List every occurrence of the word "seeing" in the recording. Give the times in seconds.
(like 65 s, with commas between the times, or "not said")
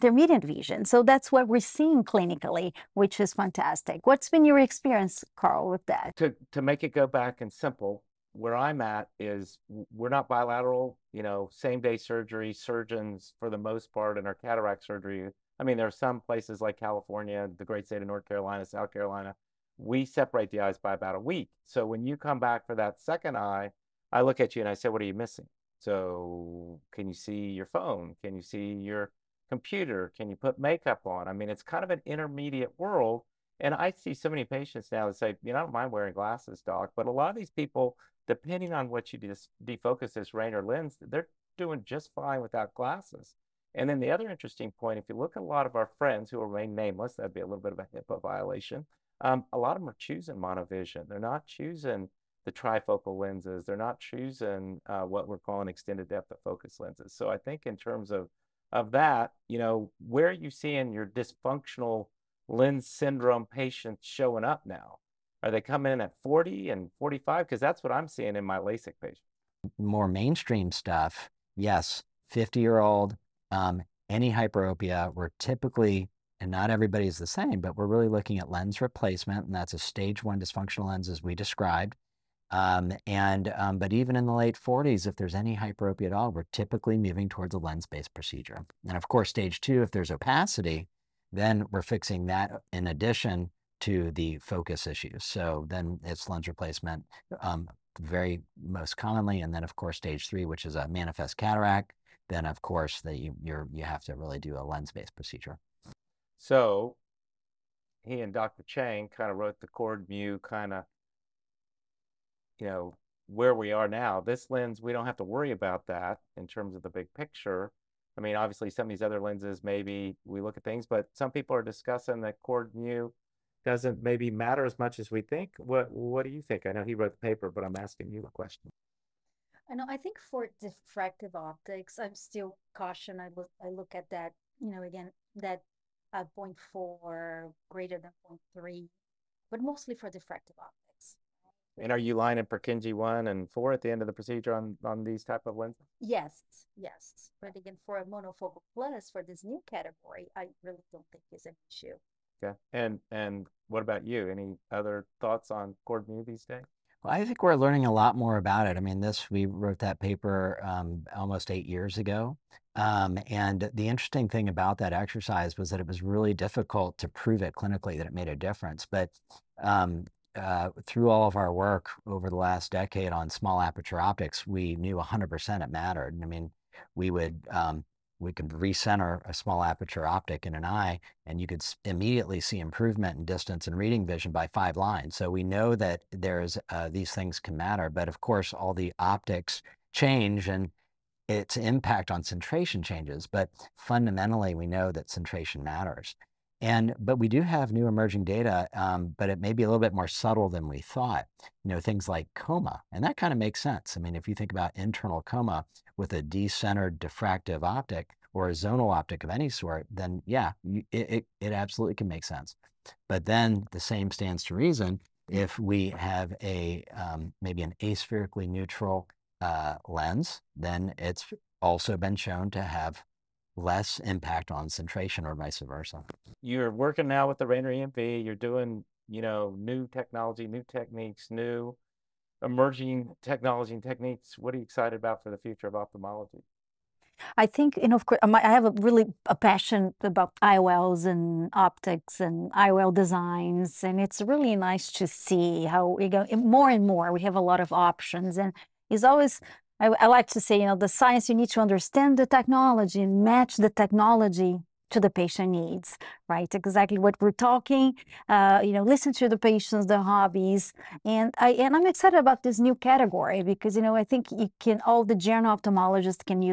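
1 s, 60 s, 68 s.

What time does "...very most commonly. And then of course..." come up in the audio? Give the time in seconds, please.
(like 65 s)
98 s.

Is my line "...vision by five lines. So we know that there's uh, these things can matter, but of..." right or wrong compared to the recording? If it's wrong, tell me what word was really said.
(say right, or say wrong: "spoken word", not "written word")
right.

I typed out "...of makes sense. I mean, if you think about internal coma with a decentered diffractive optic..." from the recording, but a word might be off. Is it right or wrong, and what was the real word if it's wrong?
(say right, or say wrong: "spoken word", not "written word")
right.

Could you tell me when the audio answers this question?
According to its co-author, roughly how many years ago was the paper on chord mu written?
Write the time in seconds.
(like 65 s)
161 s.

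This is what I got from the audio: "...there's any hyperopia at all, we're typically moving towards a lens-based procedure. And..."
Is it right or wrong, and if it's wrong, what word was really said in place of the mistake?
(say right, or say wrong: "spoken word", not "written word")
right.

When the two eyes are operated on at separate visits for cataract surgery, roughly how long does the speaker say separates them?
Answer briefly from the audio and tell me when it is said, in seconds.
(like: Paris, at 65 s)
About a week, at 20 s.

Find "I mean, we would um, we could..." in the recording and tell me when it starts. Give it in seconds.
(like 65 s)
176 s.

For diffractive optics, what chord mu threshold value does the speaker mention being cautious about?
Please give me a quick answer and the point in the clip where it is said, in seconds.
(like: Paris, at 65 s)
0.4, at 136 s.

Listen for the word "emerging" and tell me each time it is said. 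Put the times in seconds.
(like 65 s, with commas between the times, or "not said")
197 s, 232 s.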